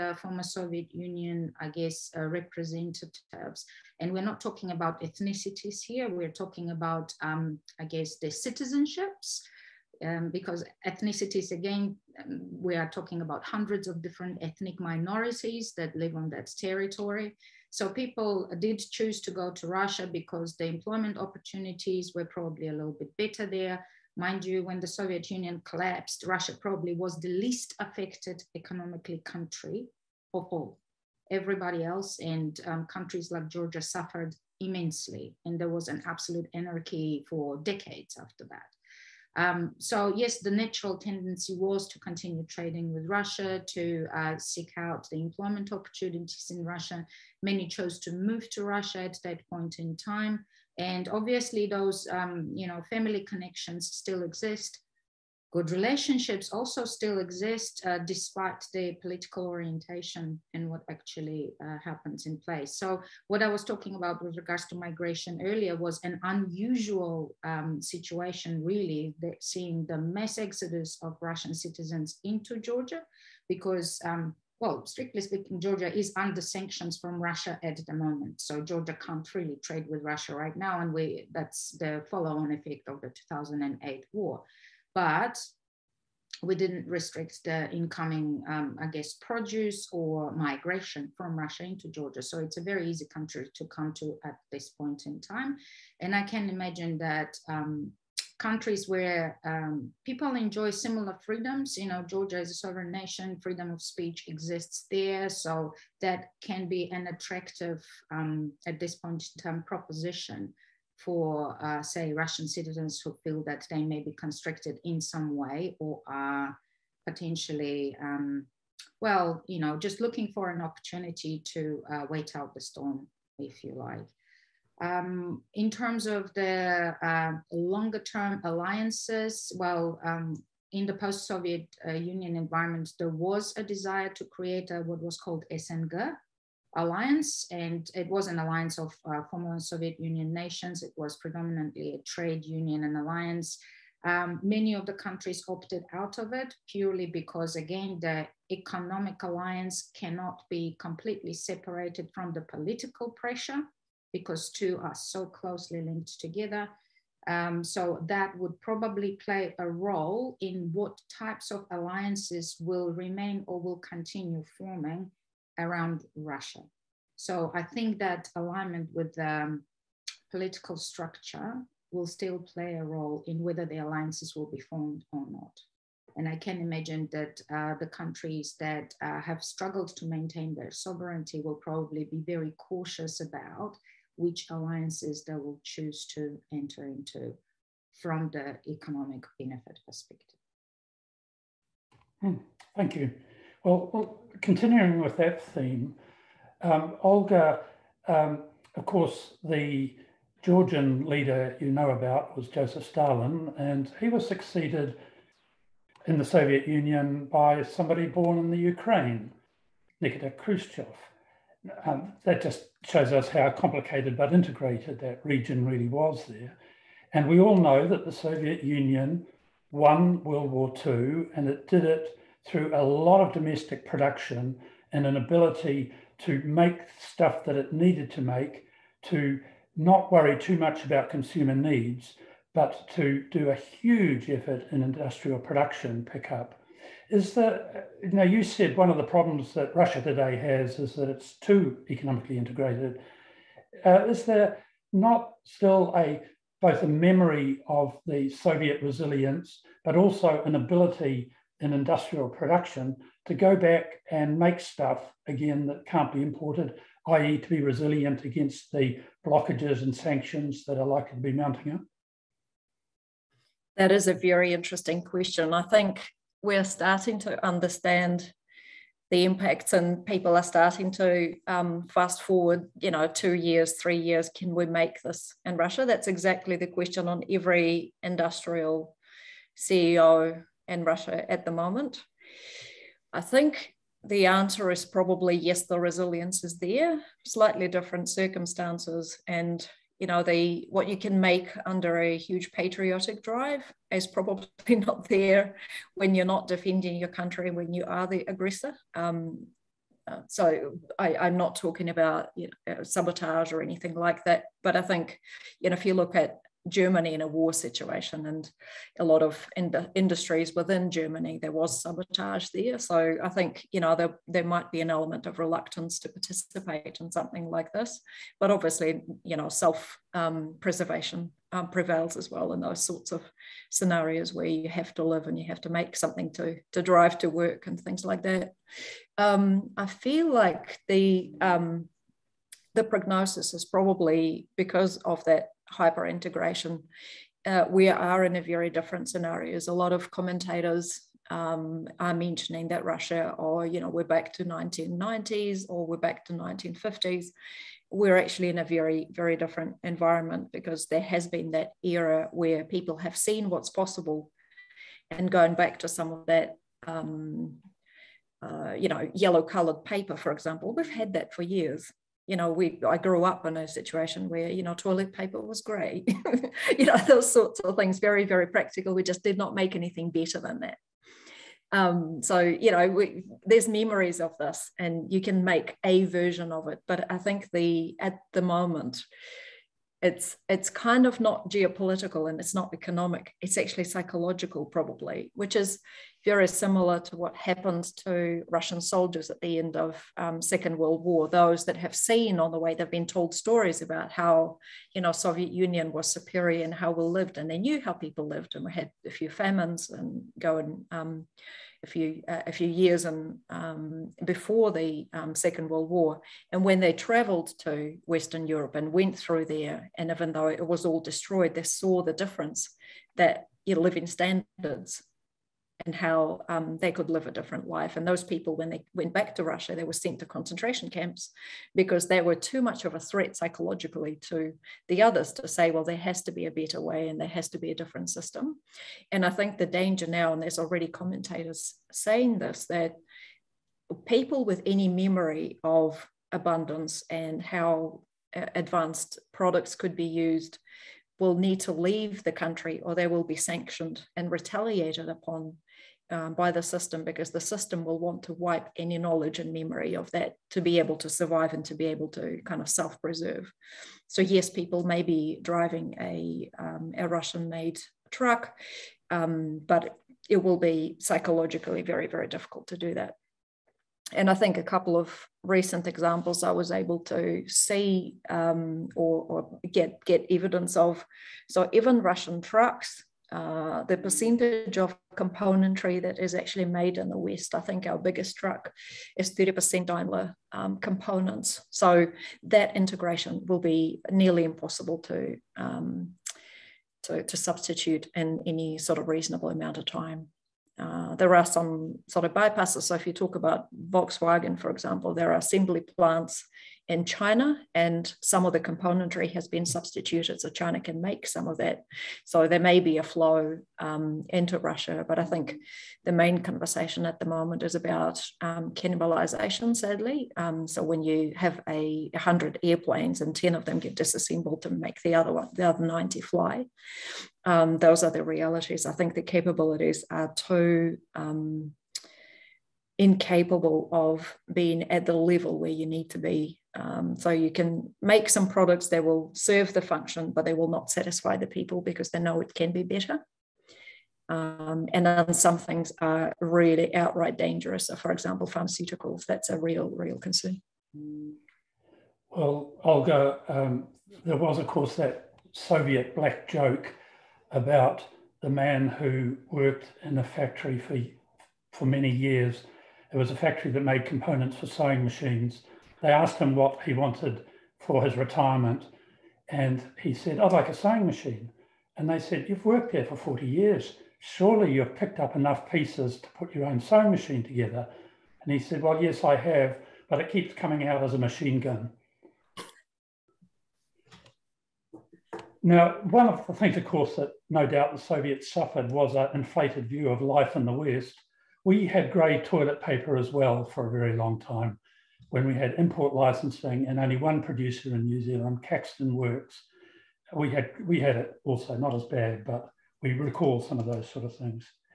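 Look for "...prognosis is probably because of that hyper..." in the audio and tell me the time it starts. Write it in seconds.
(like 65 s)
332 s.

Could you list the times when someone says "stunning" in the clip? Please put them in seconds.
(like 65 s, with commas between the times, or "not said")
not said.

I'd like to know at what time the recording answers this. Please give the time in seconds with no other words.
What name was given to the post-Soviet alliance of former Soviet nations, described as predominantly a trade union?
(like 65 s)
135 s.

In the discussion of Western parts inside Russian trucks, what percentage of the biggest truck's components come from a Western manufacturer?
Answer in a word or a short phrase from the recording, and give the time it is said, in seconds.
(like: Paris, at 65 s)
30%, at 479 s.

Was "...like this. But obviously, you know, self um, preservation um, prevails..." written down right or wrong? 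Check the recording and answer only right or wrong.
right.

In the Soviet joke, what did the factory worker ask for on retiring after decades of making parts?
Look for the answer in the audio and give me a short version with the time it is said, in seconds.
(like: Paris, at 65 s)
A sewing machine, at 560 s.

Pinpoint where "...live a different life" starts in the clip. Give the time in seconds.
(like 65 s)
417 s.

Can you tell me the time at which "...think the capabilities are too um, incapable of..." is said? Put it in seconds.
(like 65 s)
518 s.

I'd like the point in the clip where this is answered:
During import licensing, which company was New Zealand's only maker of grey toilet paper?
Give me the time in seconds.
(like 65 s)
588 s.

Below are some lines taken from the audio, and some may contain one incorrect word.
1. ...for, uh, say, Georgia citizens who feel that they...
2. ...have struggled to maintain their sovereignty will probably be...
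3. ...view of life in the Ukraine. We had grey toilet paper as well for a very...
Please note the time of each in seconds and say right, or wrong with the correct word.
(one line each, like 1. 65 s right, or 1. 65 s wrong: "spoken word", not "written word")
1. 111 s wrong: "Russian", not "Georgia"
2. 179 s right
3. 579 s wrong: "West", not "Ukraine".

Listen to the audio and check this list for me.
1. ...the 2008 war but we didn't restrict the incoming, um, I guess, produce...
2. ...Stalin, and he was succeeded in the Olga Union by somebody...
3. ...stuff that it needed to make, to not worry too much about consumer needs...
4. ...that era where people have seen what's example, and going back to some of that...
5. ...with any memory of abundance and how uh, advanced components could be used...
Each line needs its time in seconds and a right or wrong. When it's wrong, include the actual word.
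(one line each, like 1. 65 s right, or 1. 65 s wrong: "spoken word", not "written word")
1. 83 s right
2. 202 s wrong: "Soviet", not "Olga"
3. 226 s right
4. 351 s wrong: "possible", not "example"
5. 434 s wrong: "products", not "components".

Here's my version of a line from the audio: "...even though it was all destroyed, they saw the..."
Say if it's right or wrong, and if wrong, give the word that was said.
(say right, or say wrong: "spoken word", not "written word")
right.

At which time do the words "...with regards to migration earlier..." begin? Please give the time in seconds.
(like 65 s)
64 s.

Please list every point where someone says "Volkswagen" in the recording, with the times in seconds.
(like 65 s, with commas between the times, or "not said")
493 s.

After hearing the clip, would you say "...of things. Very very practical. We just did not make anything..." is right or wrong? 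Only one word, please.
right.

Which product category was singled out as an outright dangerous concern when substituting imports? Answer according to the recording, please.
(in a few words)
Pharmaceuticals.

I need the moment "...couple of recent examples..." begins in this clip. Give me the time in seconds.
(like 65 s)
464 s.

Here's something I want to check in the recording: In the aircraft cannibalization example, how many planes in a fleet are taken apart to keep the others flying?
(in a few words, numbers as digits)
10.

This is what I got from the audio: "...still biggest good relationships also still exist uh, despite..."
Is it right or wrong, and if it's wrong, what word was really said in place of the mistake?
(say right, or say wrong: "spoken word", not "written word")
wrong: "exist", not "biggest".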